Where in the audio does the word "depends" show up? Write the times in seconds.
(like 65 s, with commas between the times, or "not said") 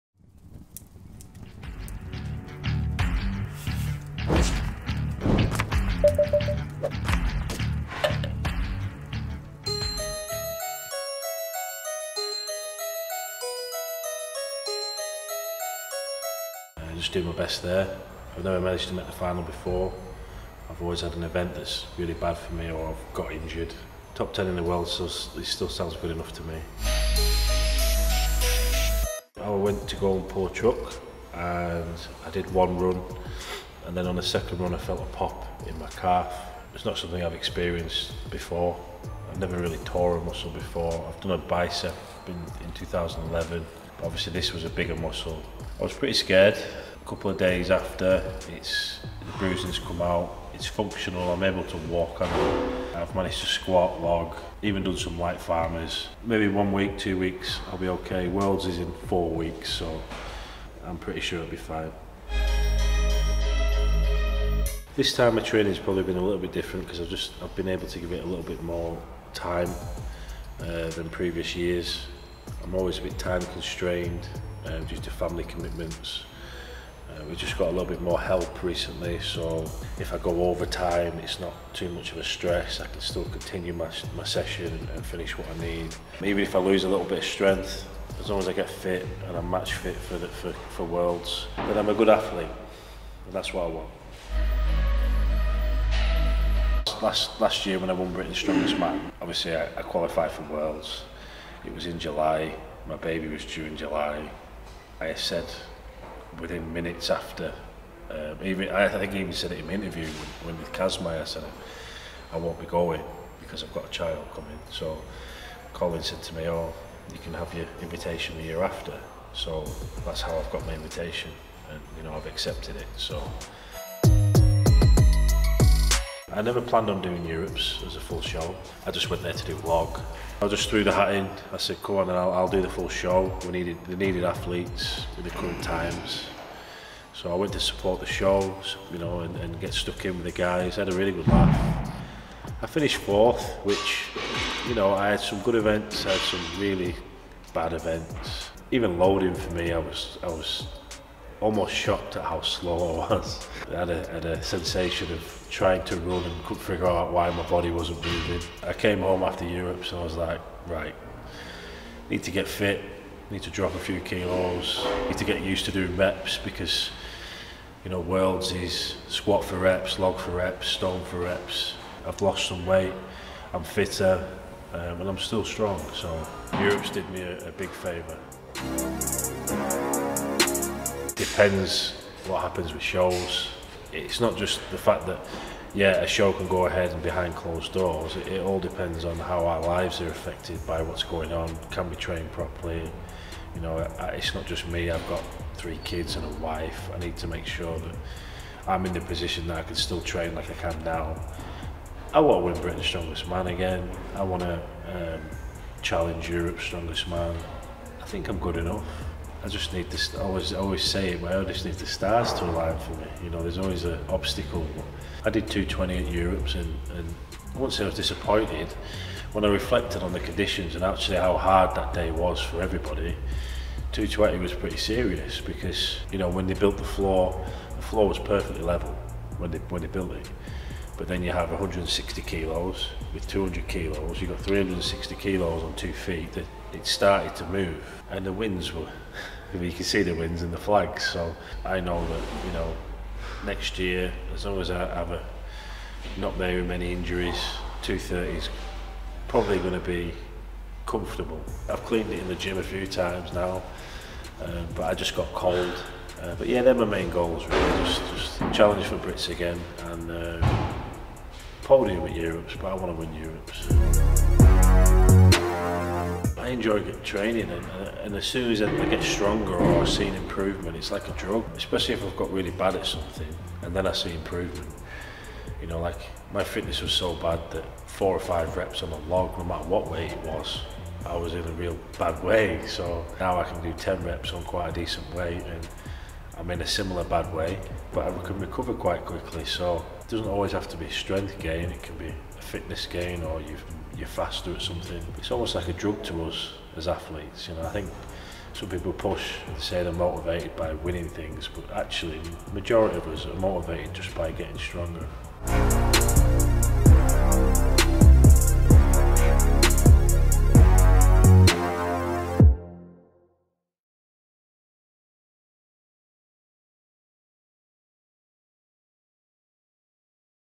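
181 s, 188 s.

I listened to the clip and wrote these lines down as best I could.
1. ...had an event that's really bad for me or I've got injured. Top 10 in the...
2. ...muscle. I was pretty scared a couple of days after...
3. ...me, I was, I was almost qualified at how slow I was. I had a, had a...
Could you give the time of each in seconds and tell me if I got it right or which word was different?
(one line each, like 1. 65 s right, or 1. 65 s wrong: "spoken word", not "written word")
1. 21 s right
2. 44 s right
3. 149 s wrong: "shocked", not "qualified".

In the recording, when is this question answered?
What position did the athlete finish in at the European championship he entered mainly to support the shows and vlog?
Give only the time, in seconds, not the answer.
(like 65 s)
142 s.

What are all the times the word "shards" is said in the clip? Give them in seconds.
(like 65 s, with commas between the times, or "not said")
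not said.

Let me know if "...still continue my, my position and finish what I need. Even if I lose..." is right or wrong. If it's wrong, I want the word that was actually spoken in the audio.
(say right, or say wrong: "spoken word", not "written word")
wrong: "session", not "position".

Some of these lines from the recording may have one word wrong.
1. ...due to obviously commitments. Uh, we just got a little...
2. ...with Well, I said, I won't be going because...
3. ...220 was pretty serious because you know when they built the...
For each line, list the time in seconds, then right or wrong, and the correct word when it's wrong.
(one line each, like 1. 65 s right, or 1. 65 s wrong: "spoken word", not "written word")
1. 74 s wrong: "family", not "obviously"
2. 110 s wrong: "Kazmai", not "Well"
3. 223 s right.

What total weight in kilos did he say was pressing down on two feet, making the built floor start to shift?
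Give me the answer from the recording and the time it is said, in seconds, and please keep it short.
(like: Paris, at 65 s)
360 kilos, at 234 s.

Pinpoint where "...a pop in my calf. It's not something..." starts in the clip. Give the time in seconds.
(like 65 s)
35 s.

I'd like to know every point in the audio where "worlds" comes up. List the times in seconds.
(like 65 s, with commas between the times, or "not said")
24 s, 58 s, 90 s, 100 s, 167 s.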